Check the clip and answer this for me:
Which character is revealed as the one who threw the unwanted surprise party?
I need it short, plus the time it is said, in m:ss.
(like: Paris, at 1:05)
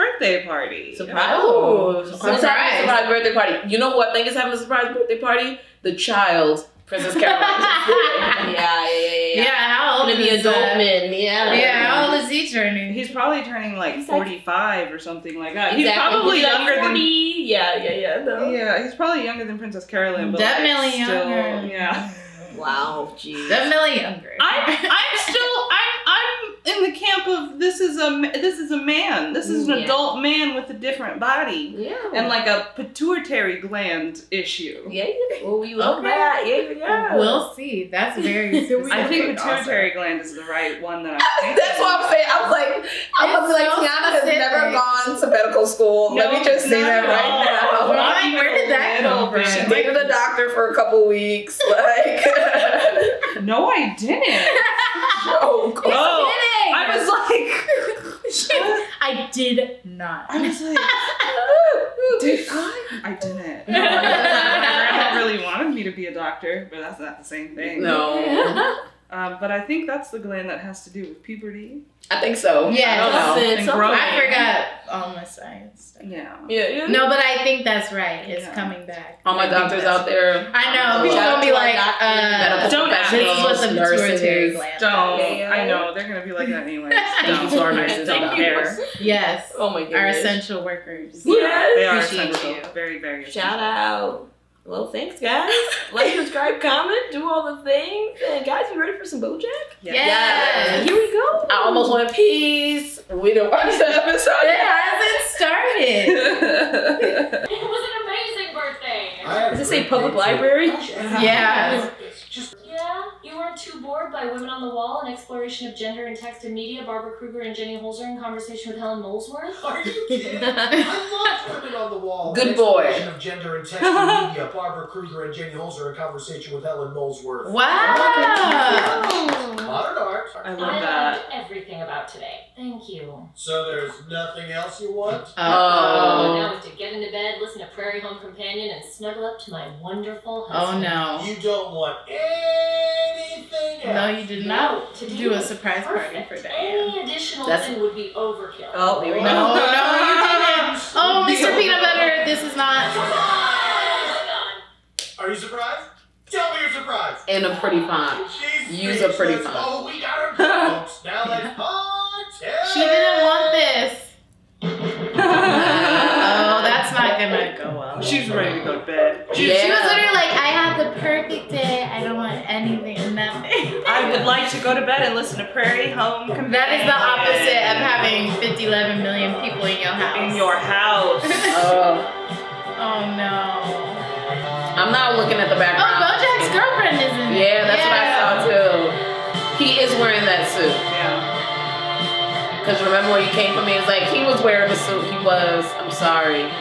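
Mr. Peanut Butter, at 2:31.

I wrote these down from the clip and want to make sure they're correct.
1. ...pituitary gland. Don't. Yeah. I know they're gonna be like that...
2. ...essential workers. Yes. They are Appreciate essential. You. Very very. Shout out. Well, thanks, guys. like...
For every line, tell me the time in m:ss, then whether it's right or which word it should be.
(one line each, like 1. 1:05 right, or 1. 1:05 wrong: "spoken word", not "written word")
1. 1:23 right
2. 1:30 right.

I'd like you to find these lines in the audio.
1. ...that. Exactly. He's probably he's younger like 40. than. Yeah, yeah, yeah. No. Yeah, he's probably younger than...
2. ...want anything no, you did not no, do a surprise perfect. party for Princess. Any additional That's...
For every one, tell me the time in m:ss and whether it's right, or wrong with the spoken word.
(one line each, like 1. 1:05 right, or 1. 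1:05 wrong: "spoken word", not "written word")
1. 0:15 right
2. 2:21 wrong: "Diane", not "Princess".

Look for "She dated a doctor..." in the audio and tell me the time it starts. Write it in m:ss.
0:49.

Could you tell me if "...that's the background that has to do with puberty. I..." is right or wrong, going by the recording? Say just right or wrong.
wrong.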